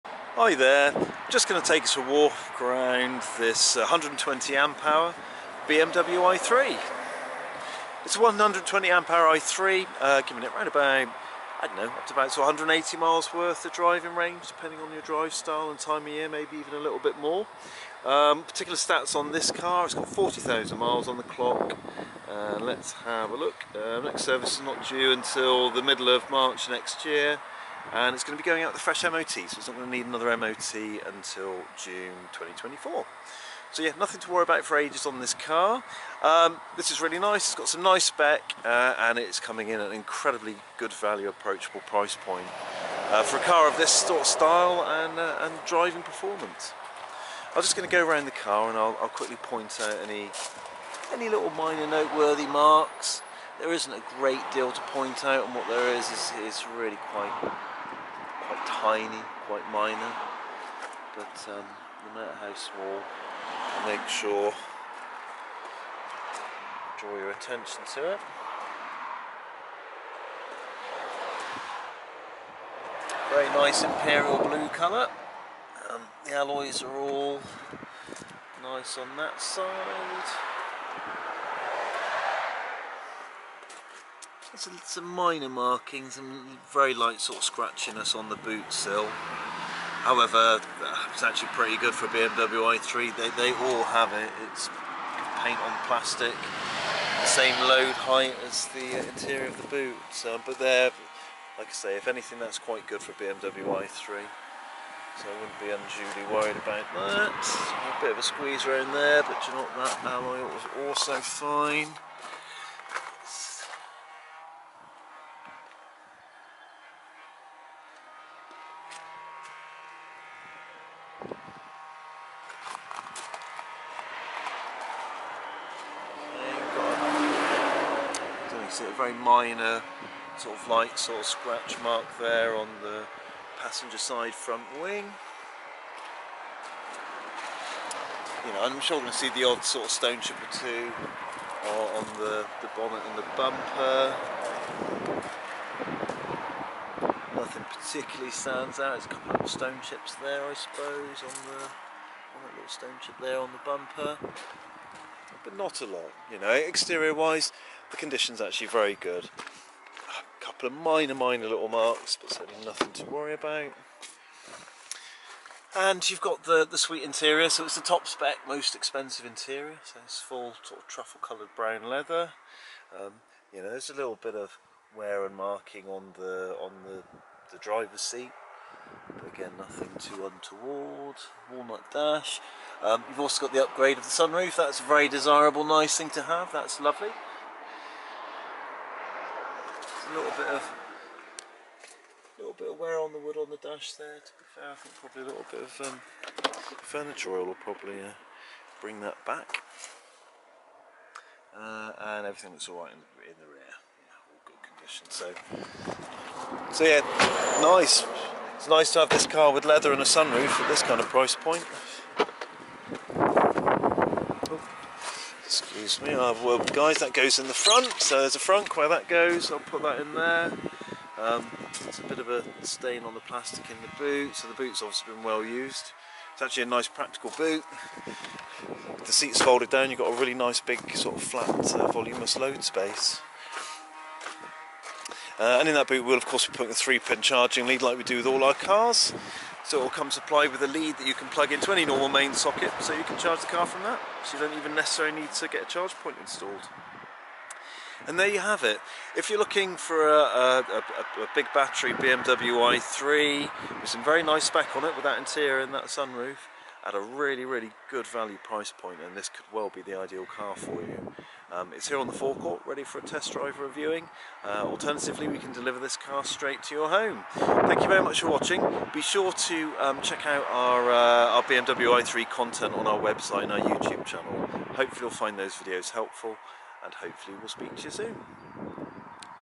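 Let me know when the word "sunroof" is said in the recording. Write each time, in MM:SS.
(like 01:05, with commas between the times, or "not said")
03:04, 03:30, 04:15.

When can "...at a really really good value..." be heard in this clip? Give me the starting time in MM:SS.
04:16.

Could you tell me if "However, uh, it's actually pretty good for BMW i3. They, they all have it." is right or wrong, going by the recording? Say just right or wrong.
right.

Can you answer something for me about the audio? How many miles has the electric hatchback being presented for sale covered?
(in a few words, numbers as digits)
40,000.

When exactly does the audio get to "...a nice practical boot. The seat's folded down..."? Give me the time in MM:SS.
03:46.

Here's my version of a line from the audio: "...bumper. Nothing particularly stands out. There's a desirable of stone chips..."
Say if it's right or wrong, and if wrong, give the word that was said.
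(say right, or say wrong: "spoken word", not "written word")
wrong: "couple", not "desirable".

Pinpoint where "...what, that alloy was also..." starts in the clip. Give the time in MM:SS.
01:49.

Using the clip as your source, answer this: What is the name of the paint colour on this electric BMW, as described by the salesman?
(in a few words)
Imperial blue.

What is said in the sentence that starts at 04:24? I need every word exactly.
Uh, alternatively, we can deliver this car straight to your home.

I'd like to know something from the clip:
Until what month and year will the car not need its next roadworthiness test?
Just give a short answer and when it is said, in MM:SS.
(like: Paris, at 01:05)
June 2024, at 00:31.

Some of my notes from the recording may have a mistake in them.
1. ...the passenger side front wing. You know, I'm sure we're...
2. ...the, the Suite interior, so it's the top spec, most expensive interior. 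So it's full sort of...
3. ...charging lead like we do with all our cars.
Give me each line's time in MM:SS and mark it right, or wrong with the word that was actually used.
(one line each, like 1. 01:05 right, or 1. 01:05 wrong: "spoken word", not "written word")
1. 02:12 right
2. 02:46 right
3. 03:57 right.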